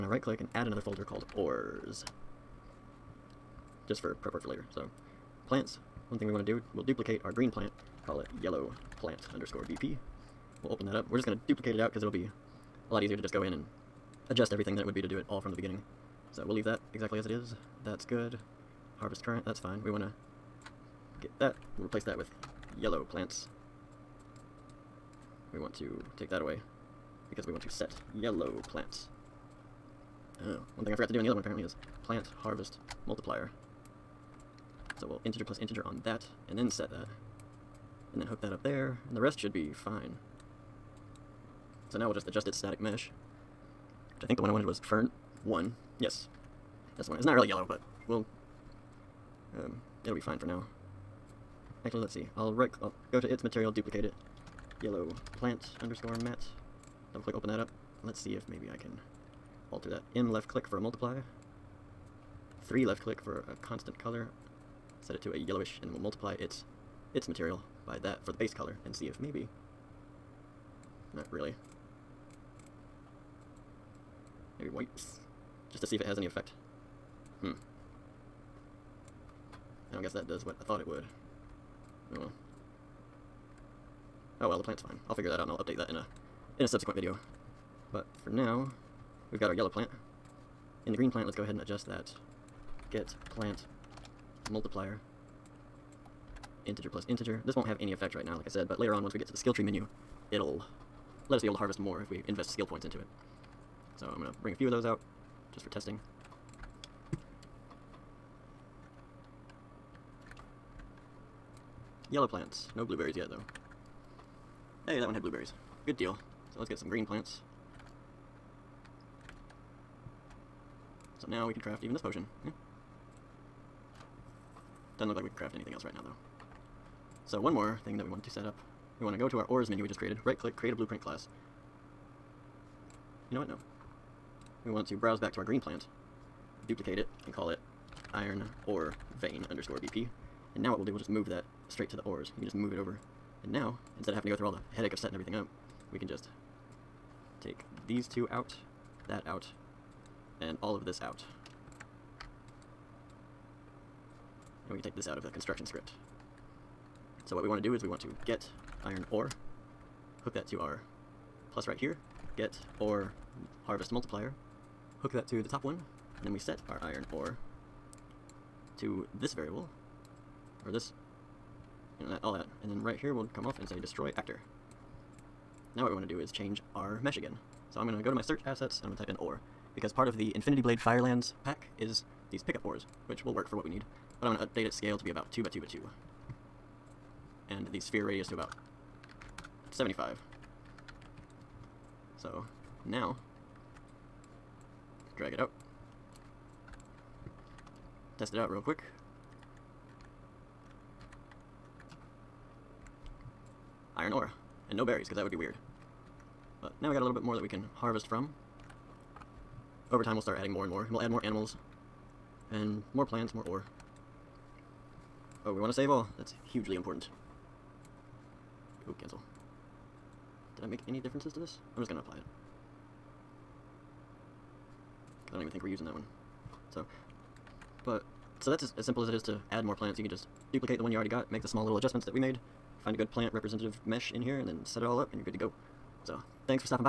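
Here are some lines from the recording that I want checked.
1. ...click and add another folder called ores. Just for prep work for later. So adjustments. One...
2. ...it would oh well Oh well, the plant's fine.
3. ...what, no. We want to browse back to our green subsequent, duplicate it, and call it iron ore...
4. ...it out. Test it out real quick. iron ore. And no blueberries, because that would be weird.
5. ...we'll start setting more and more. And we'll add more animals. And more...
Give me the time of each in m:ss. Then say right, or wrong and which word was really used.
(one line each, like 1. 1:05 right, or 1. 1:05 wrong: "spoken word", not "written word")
1. 0:00 wrong: "plants", not "adjustments"
2. 1:20 right
3. 2:13 wrong: "plant", not "subsequent"
4. 3:15 wrong: "berries", not "blueberries"
5. 3:30 wrong: "adding", not "setting".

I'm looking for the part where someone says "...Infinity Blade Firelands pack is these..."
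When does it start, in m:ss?
3:00.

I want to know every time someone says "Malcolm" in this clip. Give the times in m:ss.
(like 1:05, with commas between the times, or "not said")
not said.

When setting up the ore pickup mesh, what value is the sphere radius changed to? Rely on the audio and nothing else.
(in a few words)
75.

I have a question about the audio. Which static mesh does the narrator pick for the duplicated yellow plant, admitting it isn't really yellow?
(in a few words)
fern 1.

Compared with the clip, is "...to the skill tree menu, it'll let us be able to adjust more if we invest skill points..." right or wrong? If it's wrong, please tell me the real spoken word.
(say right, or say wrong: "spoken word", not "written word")
wrong: "harvest", not "adjust".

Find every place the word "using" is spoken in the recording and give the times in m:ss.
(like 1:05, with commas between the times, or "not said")
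3:45.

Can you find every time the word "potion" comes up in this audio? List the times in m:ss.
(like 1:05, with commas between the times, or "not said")
2:02.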